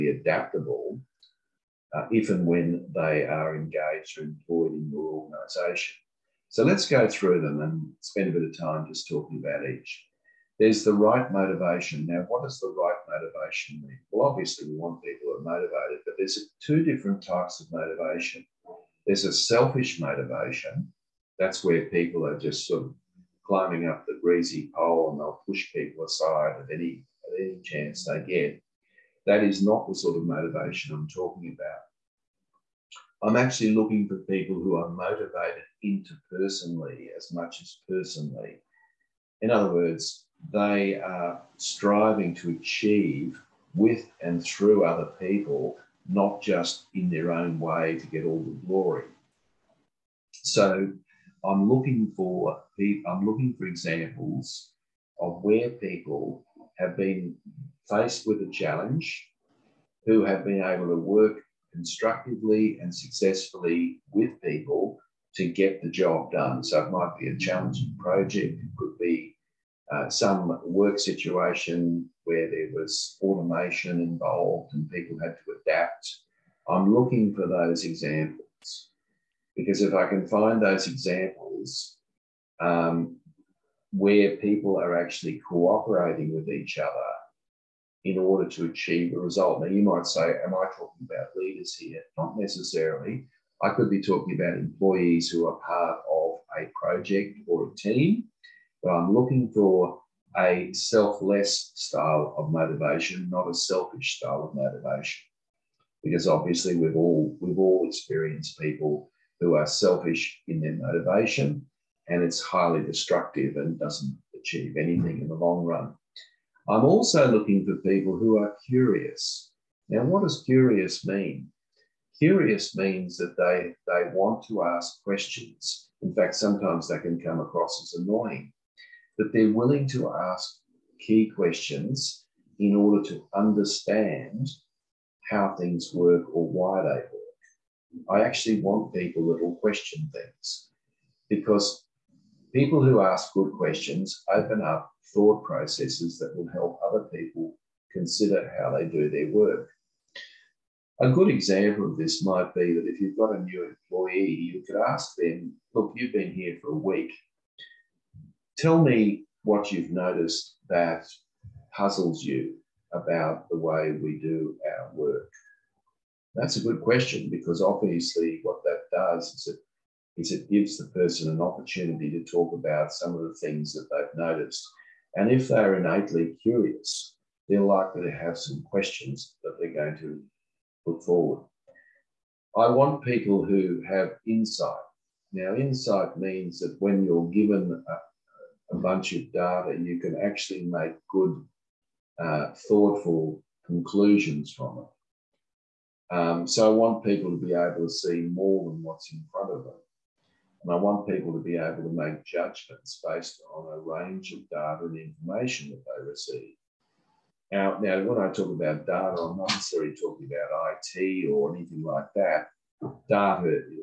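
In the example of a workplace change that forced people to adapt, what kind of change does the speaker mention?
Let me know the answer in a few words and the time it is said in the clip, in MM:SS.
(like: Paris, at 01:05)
automation, at 01:13.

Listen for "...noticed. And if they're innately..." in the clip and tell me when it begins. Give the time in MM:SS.
02:54.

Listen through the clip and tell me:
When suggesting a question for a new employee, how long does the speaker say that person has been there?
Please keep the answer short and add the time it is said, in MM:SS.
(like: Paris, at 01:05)
a week, at 02:36.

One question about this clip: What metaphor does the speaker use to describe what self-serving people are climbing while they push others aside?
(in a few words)
the greasy pole.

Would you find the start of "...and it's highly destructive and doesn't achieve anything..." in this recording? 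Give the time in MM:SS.
01:52.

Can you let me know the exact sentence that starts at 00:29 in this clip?
That is not the sort of motivation I'm talking about.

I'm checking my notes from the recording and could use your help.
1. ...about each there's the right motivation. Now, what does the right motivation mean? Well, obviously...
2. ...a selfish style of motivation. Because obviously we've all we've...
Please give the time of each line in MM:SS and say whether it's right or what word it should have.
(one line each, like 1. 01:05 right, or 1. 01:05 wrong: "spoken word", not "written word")
1. 00:09 right
2. 01:43 right.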